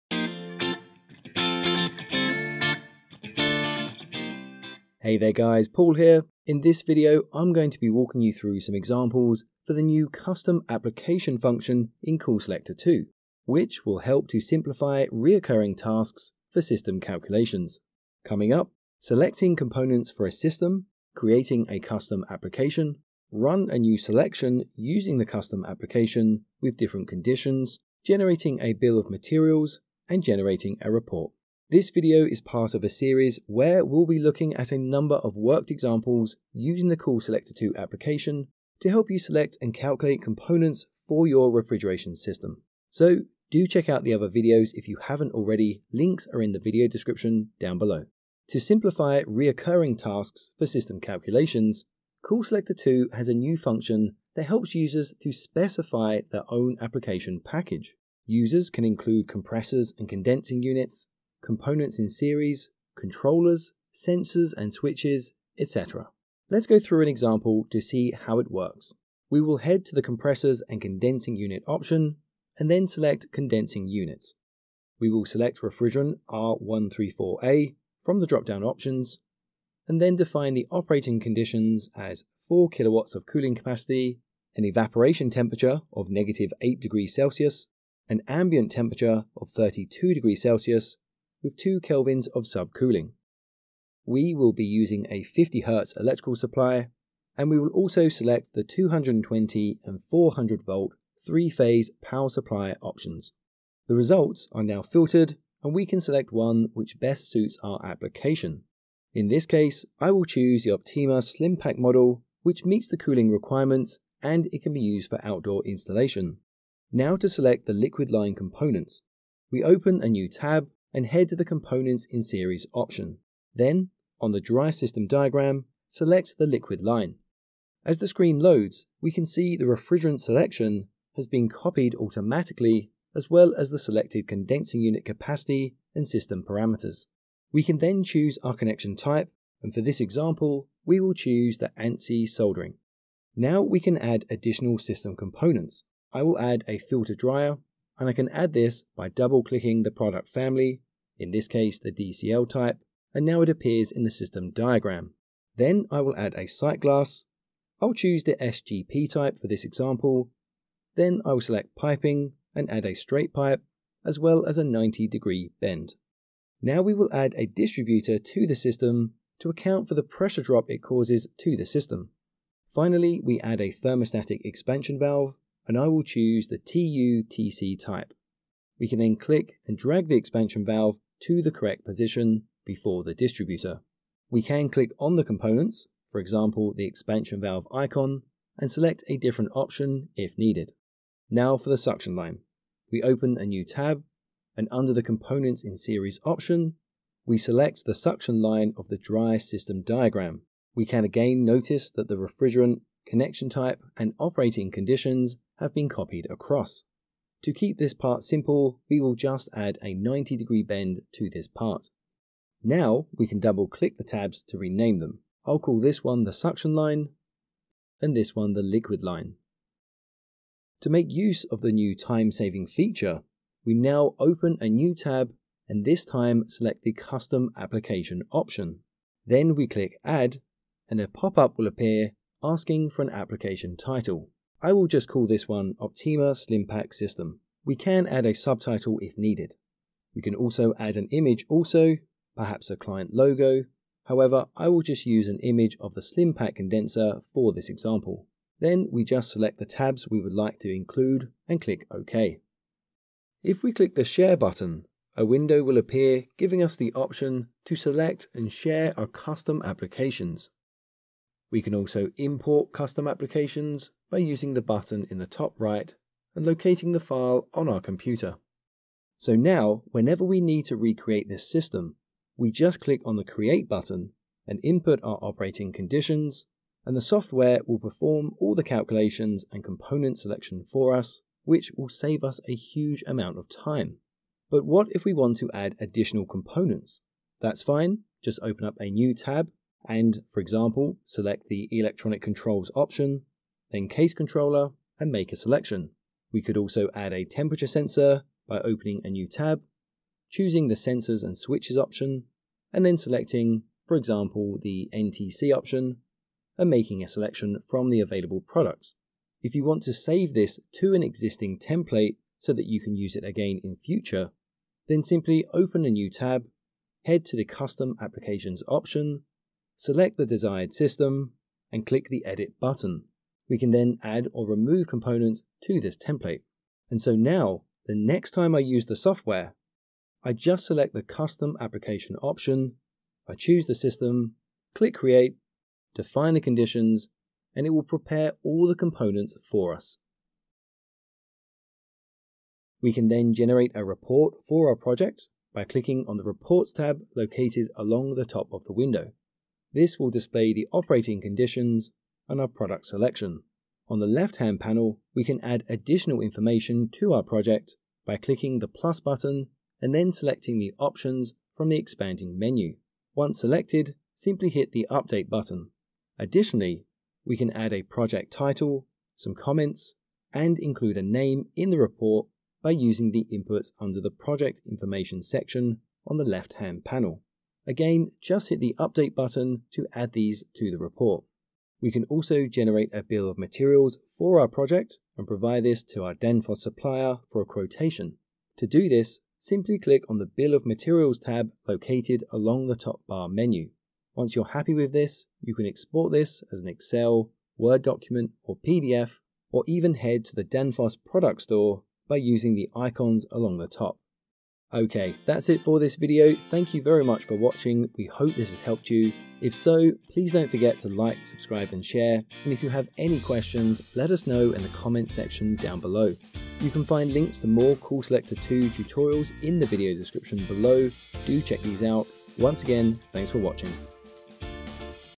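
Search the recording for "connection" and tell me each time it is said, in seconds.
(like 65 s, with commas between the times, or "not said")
138 s, 203 s.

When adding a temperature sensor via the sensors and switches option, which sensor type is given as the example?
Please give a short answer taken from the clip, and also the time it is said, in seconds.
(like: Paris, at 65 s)
NTC, at 304 s.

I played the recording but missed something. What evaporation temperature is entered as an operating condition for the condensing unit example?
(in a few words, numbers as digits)
-8 degrees Celsius.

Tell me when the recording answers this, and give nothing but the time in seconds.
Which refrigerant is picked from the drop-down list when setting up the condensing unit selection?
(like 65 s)
76 s.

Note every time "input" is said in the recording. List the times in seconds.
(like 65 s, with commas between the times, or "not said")
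274 s, 373 s.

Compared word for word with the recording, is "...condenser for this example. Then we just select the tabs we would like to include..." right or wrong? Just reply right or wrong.
right.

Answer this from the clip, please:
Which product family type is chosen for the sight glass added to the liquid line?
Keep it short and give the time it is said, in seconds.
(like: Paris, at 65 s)
SGP, at 158 s.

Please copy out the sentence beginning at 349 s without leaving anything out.
This will display the operating conditions and our product selection.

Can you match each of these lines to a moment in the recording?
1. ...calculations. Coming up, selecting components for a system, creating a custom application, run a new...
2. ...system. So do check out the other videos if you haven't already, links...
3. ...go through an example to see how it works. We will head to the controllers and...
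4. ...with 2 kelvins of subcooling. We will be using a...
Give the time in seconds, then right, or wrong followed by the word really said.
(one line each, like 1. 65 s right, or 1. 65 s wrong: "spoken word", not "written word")
1. 16 s right
2. 42 s right
3. 66 s wrong: "compressors", not "controllers"
4. 91 s right.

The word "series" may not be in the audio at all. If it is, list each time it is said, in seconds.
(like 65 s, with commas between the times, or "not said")
32 s, 62 s, 122 s, 195 s.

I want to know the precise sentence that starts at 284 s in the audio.
But what if we want to add additional components?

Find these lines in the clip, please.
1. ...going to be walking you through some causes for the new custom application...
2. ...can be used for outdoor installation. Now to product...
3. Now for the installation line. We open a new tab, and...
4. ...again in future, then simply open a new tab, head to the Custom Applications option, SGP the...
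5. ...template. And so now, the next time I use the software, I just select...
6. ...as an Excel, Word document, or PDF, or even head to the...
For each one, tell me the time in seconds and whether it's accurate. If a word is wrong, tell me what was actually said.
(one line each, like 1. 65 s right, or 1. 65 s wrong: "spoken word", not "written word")
1. 7 s wrong: "examples", not "causes"
2. 114 s wrong: "select", not "product"
3. 191 s wrong: "suction", not "installation"
4. 313 s wrong: "Select", not "SGP"
5. 325 s right
6. 396 s right.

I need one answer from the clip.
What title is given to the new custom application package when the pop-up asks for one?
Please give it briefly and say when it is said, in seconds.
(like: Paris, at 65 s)
Optyma Slimpack System, at 235 s.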